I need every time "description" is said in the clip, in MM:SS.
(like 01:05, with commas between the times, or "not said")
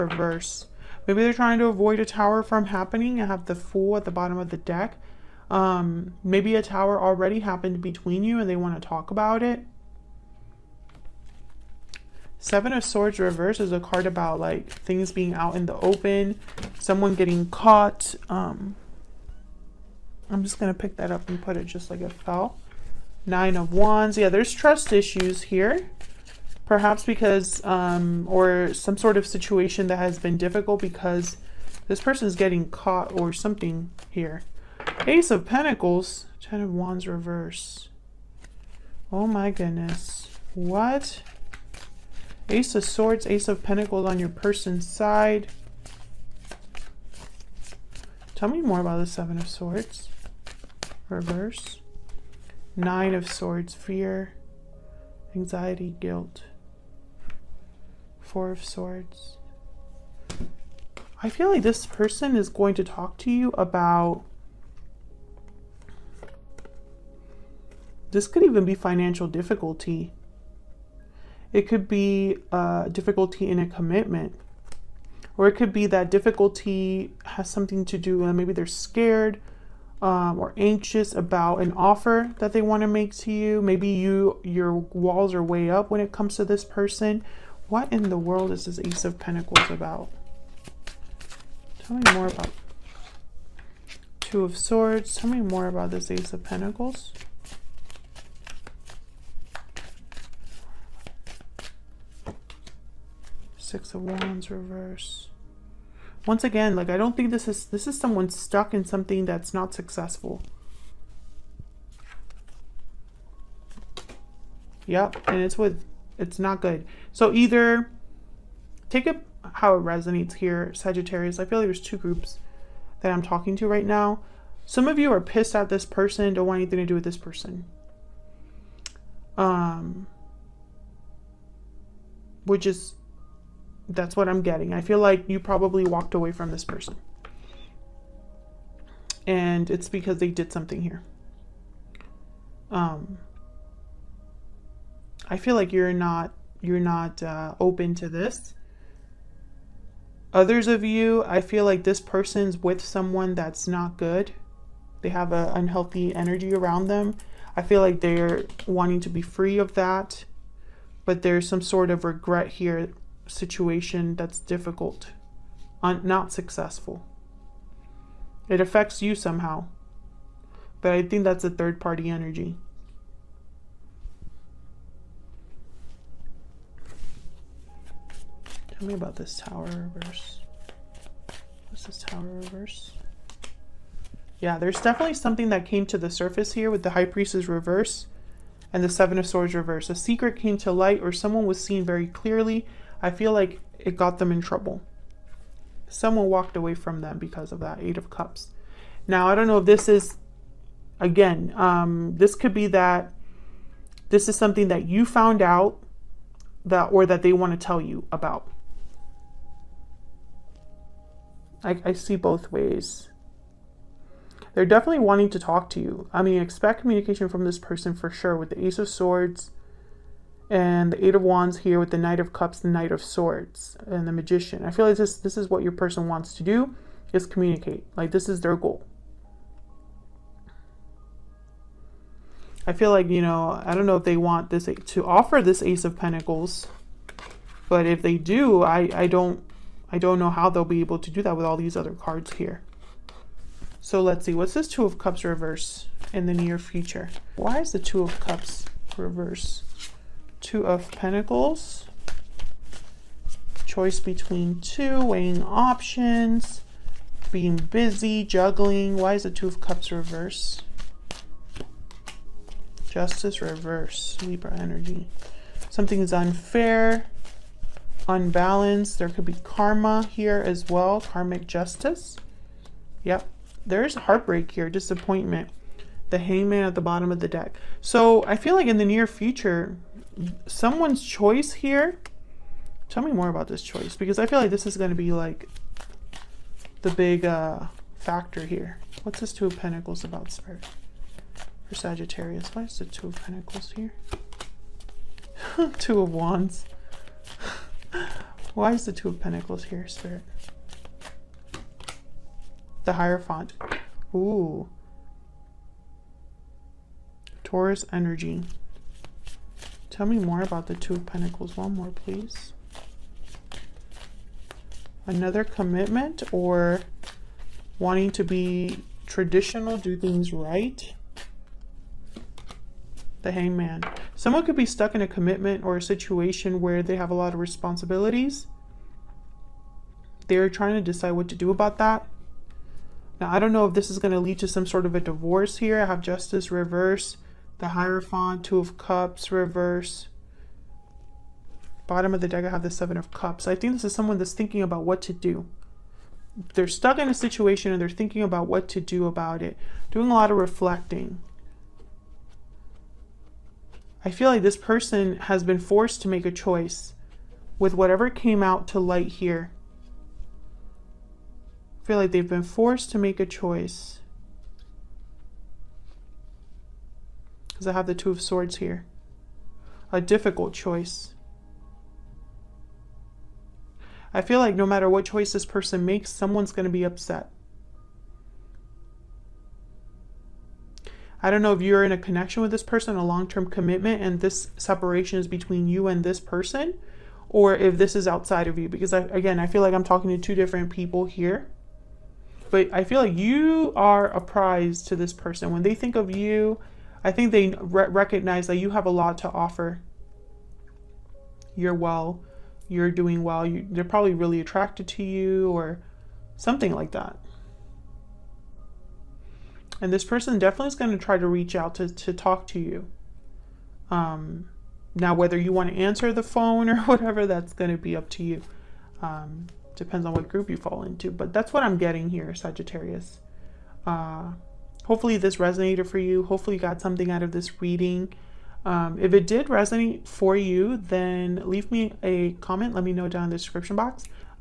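07:13.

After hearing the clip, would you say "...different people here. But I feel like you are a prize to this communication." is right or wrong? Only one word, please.
wrong.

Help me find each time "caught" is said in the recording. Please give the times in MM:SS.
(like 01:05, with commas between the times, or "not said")
00:17, 00:32.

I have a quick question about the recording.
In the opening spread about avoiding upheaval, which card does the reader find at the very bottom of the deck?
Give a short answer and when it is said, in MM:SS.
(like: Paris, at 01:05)
The Fool, at 00:03.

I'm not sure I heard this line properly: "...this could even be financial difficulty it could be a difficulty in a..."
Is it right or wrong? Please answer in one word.
right.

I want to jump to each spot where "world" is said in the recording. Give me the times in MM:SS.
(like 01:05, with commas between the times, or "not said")
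01:28.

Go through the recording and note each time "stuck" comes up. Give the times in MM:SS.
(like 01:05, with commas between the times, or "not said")
01:48, 05:24, 05:46.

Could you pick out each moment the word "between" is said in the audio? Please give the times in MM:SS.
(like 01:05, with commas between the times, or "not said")
00:07, 04:13, 06:25.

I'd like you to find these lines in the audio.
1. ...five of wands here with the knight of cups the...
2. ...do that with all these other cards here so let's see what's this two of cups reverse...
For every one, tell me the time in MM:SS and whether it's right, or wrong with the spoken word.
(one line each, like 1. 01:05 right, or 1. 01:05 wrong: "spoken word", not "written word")
1. 03:41 wrong: "eight", not "five"
2. 04:01 right.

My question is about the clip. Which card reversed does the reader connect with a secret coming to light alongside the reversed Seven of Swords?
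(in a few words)
High Priestess.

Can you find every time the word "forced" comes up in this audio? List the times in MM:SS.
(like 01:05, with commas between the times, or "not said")
05:55, 06:02.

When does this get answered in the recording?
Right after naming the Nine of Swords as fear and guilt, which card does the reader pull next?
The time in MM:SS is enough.
00:58.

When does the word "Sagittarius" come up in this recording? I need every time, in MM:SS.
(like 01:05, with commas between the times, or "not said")
02:00, 04:51, 07:02.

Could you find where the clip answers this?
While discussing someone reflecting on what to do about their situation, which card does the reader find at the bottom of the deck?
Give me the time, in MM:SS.
05:42.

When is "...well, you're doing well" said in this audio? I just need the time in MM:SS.
06:41.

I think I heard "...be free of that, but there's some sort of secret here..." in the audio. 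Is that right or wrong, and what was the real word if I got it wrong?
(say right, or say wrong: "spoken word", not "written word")
wrong: "regret", not "secret".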